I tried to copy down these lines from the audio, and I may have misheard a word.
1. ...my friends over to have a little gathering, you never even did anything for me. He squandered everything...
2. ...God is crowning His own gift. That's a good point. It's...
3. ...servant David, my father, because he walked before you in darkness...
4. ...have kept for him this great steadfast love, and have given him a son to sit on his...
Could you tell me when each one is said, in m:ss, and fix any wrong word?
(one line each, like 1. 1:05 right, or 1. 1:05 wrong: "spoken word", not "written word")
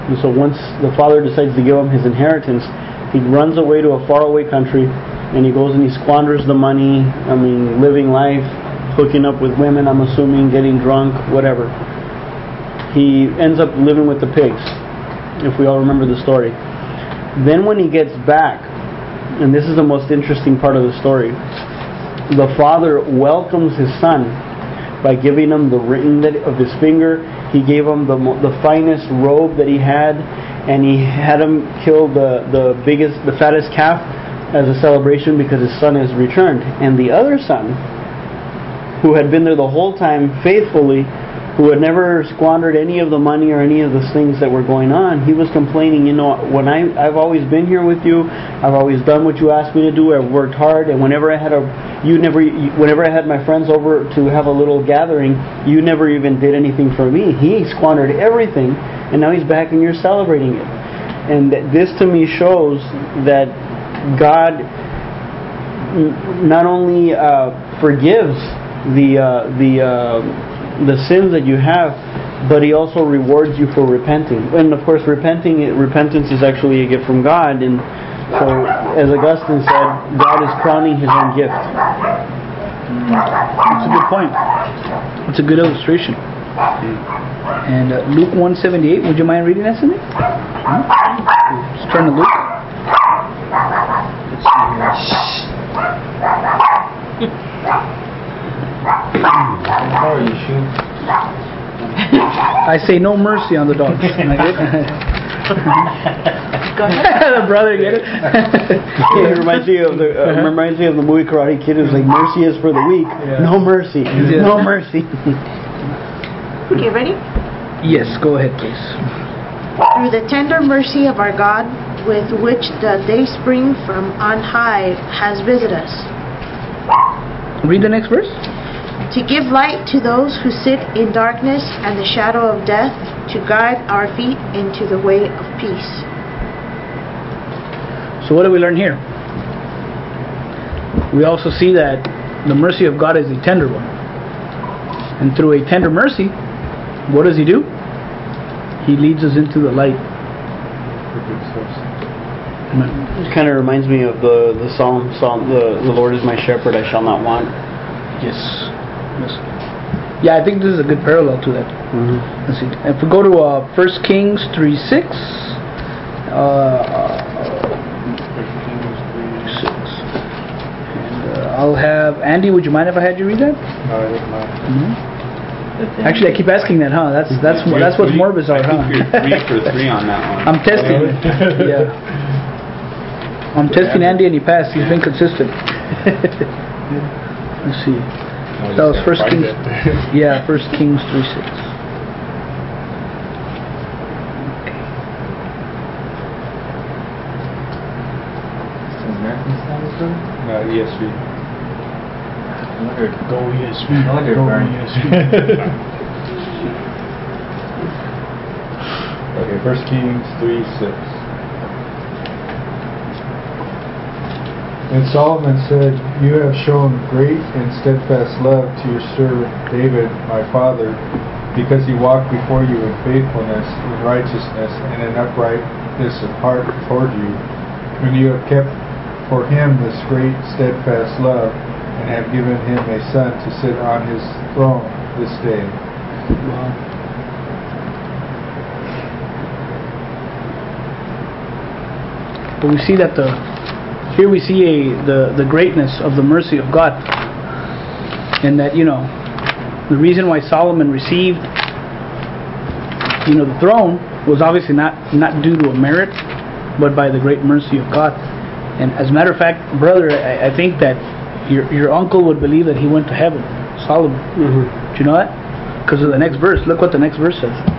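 1. 0:53 right
2. 1:20 right
3. 3:39 wrong: "faithfulness", not "darkness"
4. 3:48 right.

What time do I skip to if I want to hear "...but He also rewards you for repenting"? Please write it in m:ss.
1:12.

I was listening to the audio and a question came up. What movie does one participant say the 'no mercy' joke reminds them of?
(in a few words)
Karate Kid.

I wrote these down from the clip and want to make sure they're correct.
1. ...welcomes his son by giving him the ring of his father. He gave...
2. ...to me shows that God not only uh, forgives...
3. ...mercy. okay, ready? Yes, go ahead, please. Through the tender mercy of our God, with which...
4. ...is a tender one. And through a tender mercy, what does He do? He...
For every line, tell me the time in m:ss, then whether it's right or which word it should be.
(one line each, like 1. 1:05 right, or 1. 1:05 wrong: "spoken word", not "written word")
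1. 0:22 wrong: "finger", not "father"
2. 1:01 right
3. 1:54 right
4. 2:23 right.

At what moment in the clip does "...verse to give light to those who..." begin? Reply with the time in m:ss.
2:08.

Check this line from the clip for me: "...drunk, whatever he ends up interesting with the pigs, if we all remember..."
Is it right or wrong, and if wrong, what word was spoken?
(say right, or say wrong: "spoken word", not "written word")
wrong: "living", not "interesting".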